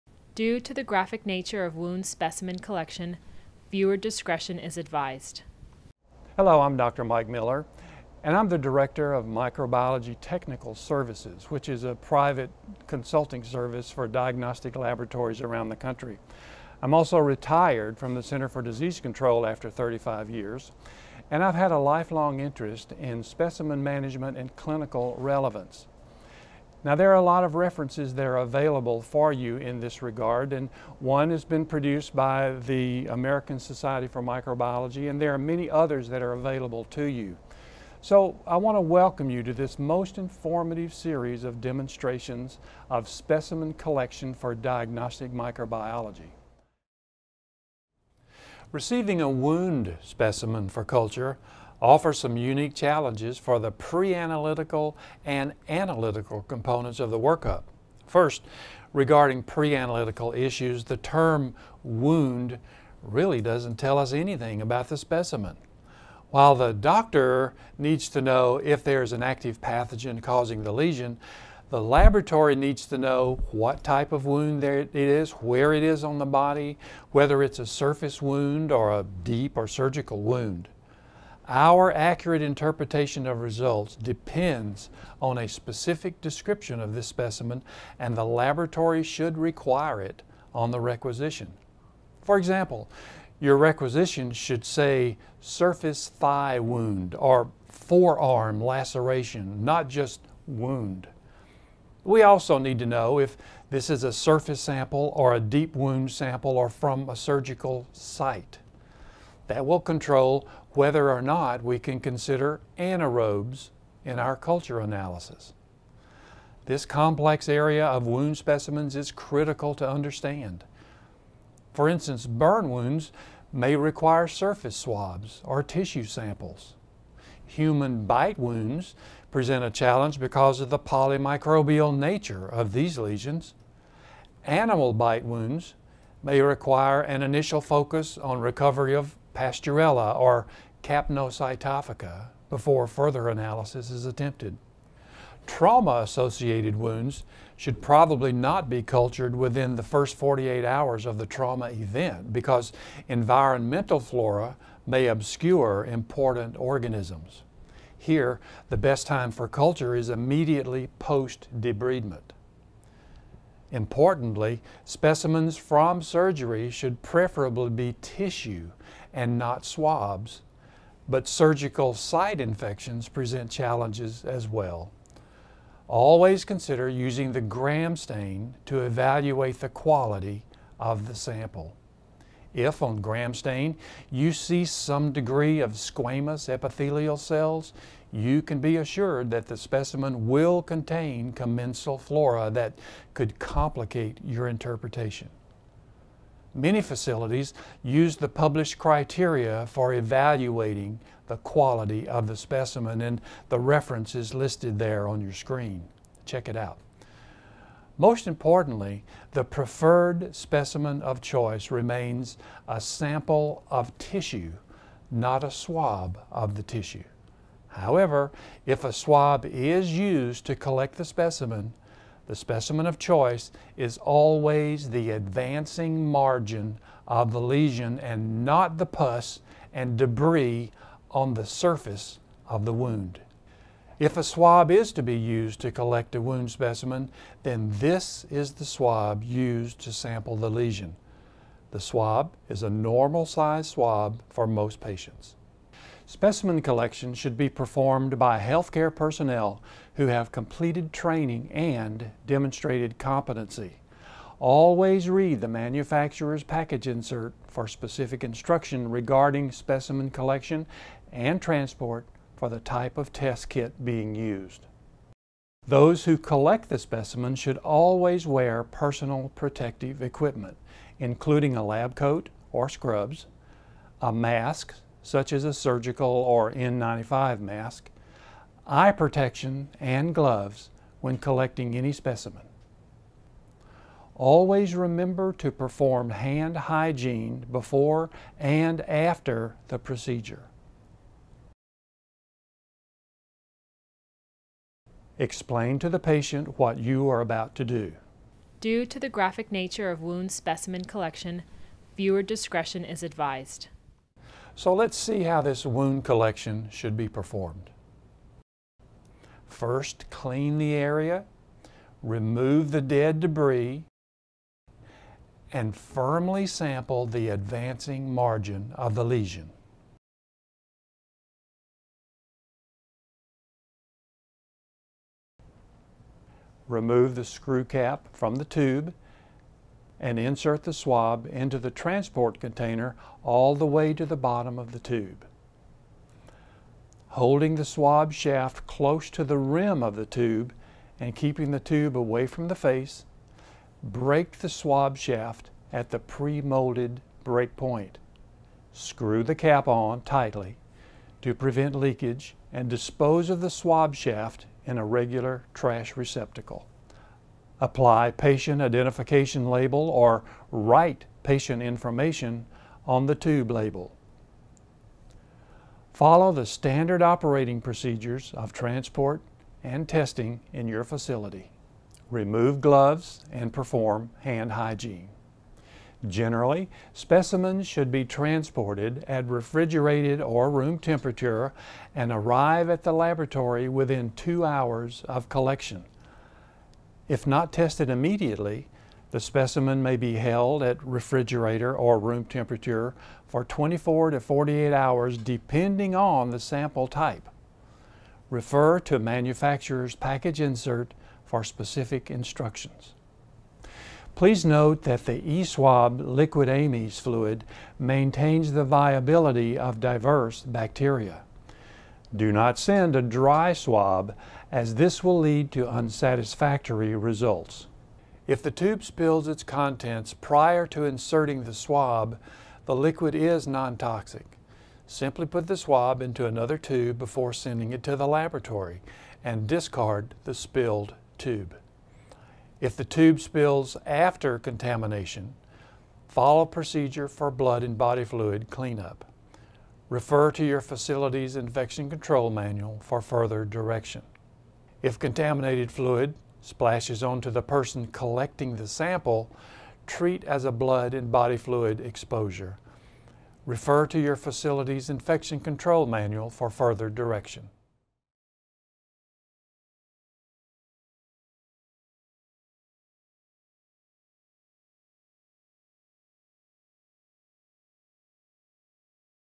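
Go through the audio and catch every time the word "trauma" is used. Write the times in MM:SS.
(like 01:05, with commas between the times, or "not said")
02:25, 02:31.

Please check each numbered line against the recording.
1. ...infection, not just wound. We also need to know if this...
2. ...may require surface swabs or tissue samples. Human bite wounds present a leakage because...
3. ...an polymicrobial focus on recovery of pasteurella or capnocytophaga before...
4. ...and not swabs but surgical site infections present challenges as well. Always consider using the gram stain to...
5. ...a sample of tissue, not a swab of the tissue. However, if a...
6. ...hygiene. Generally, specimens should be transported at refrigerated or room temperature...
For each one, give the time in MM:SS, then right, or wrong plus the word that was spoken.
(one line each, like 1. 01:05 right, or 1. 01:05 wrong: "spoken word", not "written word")
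1. 01:38 wrong: "laceration", not "infection"
2. 02:03 wrong: "challenge", not "leakage"
3. 02:17 wrong: "initial", not "polymicrobial"
4. 02:49 right
5. 03:32 right
6. 06:14 right.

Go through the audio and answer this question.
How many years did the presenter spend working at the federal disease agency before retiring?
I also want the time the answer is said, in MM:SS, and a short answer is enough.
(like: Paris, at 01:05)
35, at 00:19.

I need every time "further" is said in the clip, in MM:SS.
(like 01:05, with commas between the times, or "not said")
02:22, 07:23, 07:36.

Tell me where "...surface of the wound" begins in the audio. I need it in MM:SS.
03:51.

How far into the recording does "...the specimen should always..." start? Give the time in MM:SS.
04:26.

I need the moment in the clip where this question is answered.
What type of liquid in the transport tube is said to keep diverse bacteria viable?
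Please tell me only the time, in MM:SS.
06:45.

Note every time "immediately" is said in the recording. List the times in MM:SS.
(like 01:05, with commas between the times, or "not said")
02:40, 06:27.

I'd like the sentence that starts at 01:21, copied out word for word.
Our accurate interpretation of results depends on a specific description of this specimen and the laboratory should require it on the requisition.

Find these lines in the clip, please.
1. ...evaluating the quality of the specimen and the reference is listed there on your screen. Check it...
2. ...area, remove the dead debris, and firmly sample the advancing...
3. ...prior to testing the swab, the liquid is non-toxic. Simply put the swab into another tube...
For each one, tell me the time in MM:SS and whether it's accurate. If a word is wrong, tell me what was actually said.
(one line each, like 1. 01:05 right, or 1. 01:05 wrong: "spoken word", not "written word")
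1. 03:19 right
2. 05:10 right
3. 07:00 wrong: "inserting", not "testing".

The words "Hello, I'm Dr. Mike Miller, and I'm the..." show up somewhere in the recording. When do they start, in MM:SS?
00:06.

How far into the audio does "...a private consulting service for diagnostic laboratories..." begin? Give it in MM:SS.
00:11.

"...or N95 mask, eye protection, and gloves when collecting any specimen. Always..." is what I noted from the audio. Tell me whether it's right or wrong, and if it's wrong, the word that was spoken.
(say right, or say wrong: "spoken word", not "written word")
right.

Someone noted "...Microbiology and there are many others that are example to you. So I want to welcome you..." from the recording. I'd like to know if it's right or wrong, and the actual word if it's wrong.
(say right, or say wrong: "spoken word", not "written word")
wrong: "available", not "example".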